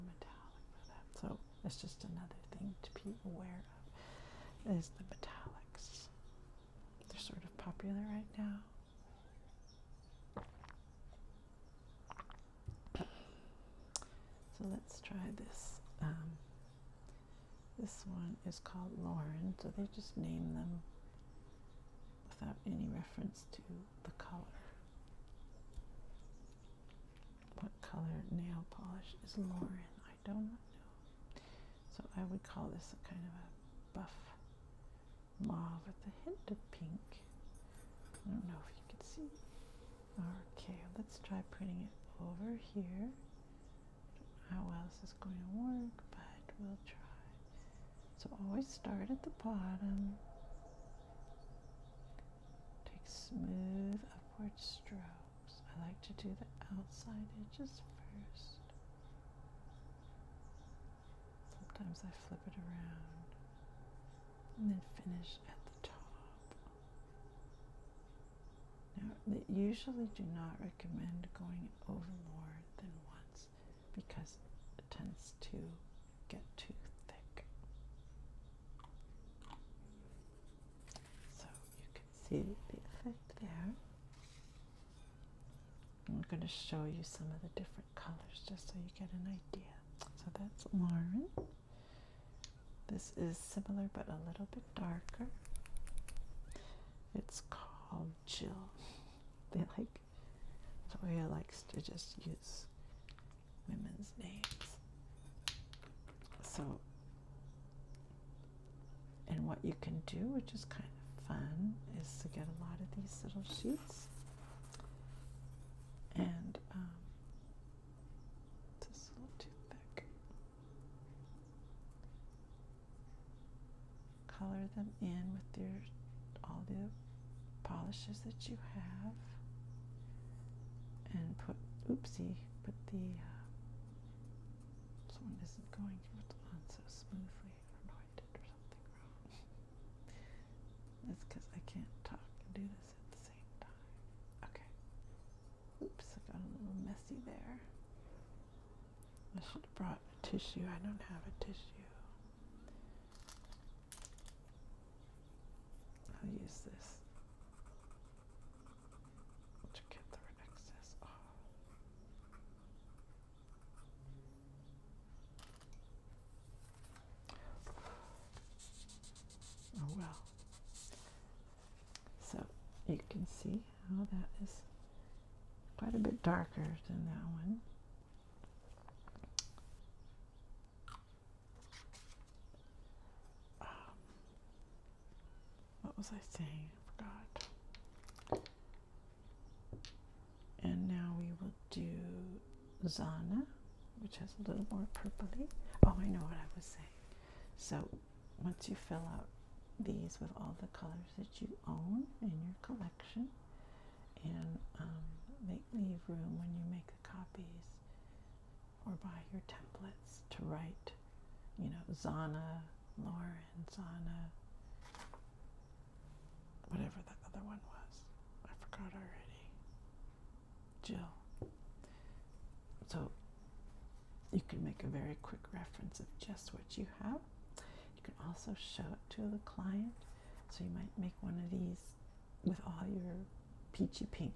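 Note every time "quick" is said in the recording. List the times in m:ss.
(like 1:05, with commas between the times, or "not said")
3:45.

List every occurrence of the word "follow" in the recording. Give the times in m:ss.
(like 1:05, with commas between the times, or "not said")
not said.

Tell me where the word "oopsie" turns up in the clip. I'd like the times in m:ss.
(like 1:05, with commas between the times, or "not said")
2:11.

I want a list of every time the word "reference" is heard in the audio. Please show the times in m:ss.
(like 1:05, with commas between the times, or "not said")
0:22, 3:45.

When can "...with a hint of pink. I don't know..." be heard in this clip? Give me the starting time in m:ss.
0:35.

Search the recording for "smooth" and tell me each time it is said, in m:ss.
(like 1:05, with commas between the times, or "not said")
0:53, 2:16.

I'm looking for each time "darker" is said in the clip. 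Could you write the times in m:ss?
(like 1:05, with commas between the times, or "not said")
1:34, 2:56.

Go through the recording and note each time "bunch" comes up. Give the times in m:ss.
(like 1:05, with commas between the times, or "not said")
not said.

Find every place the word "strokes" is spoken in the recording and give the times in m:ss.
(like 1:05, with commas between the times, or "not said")
0:54.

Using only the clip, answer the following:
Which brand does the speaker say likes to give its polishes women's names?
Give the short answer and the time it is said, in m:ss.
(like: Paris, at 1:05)
Zoya, at 1:40.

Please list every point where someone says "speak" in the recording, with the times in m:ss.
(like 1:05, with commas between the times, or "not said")
not said.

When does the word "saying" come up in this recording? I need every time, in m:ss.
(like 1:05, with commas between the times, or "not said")
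3:06, 3:16.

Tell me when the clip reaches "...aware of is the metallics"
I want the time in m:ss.
0:03.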